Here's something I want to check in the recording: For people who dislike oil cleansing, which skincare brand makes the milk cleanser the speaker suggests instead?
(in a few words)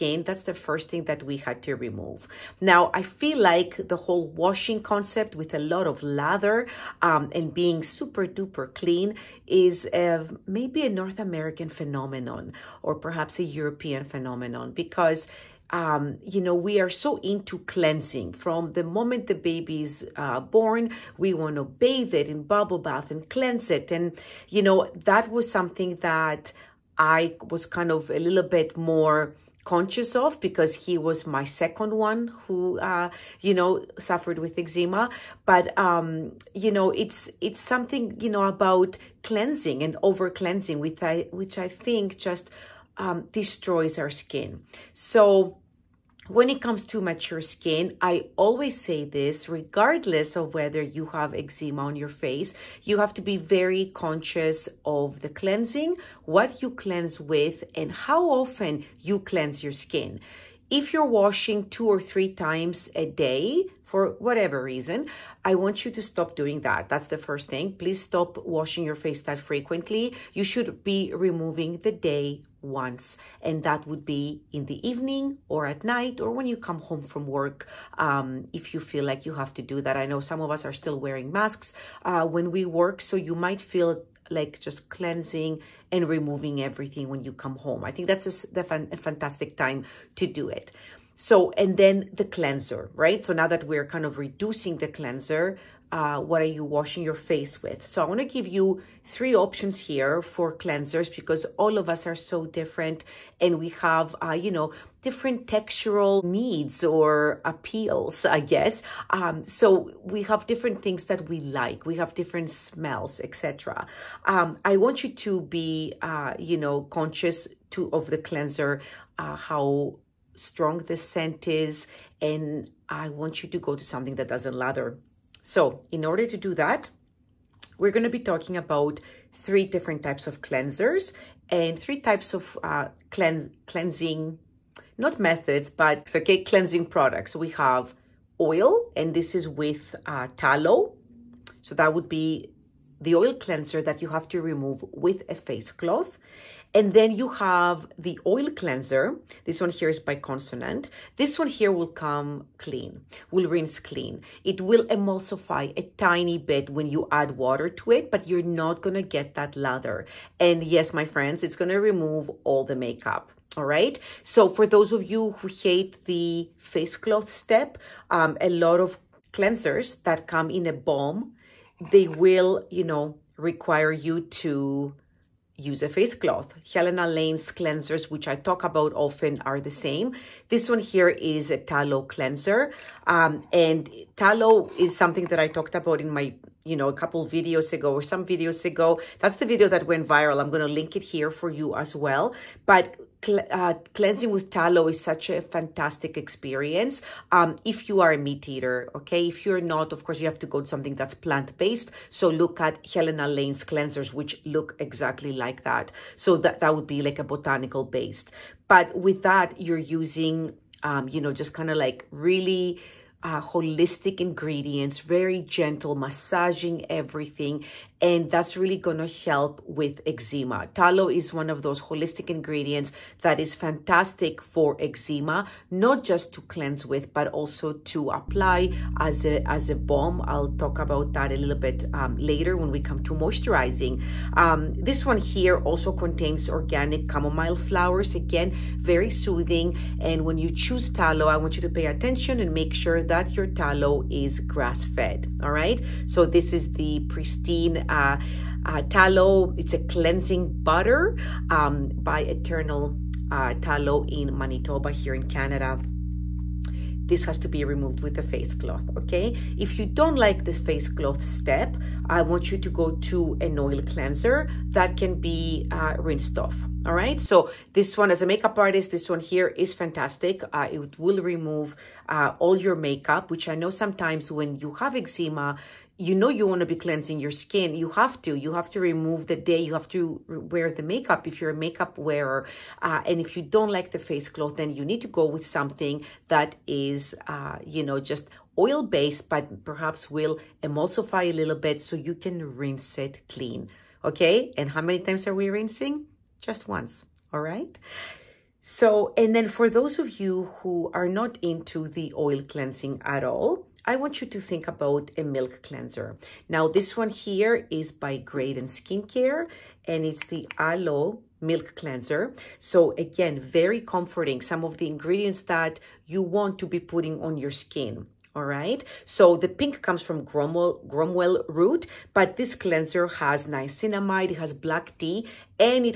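Graydon Skincare.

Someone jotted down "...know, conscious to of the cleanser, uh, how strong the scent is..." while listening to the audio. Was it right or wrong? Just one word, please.
right.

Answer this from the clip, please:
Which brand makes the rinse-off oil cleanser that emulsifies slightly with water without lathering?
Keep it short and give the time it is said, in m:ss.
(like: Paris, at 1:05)
Consonant, at 2:30.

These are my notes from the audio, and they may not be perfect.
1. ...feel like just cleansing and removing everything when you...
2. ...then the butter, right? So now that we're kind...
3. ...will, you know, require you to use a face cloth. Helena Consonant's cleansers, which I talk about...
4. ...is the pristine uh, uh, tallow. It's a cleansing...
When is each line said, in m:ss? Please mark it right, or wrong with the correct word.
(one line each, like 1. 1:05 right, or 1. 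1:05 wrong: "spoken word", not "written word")
1. 1:23 right
2. 1:31 wrong: "cleanser", not "butter"
3. 2:52 wrong: "Lane", not "Consonant"
4. 4:06 right.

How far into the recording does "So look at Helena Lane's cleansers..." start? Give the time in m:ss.
3:22.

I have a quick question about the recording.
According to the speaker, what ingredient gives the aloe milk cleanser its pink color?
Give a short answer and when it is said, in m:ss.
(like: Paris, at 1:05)
Gromwell root, at 5:20.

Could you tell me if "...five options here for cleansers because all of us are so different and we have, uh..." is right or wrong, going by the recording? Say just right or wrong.
wrong.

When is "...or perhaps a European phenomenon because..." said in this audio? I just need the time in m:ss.
0:12.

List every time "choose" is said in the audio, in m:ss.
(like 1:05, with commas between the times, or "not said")
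4:00.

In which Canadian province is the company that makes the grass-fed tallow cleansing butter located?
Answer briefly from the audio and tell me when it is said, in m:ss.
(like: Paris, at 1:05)
Manitoba, at 4:14.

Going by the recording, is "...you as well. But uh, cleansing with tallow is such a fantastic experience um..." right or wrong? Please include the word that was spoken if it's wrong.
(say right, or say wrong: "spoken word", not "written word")
right.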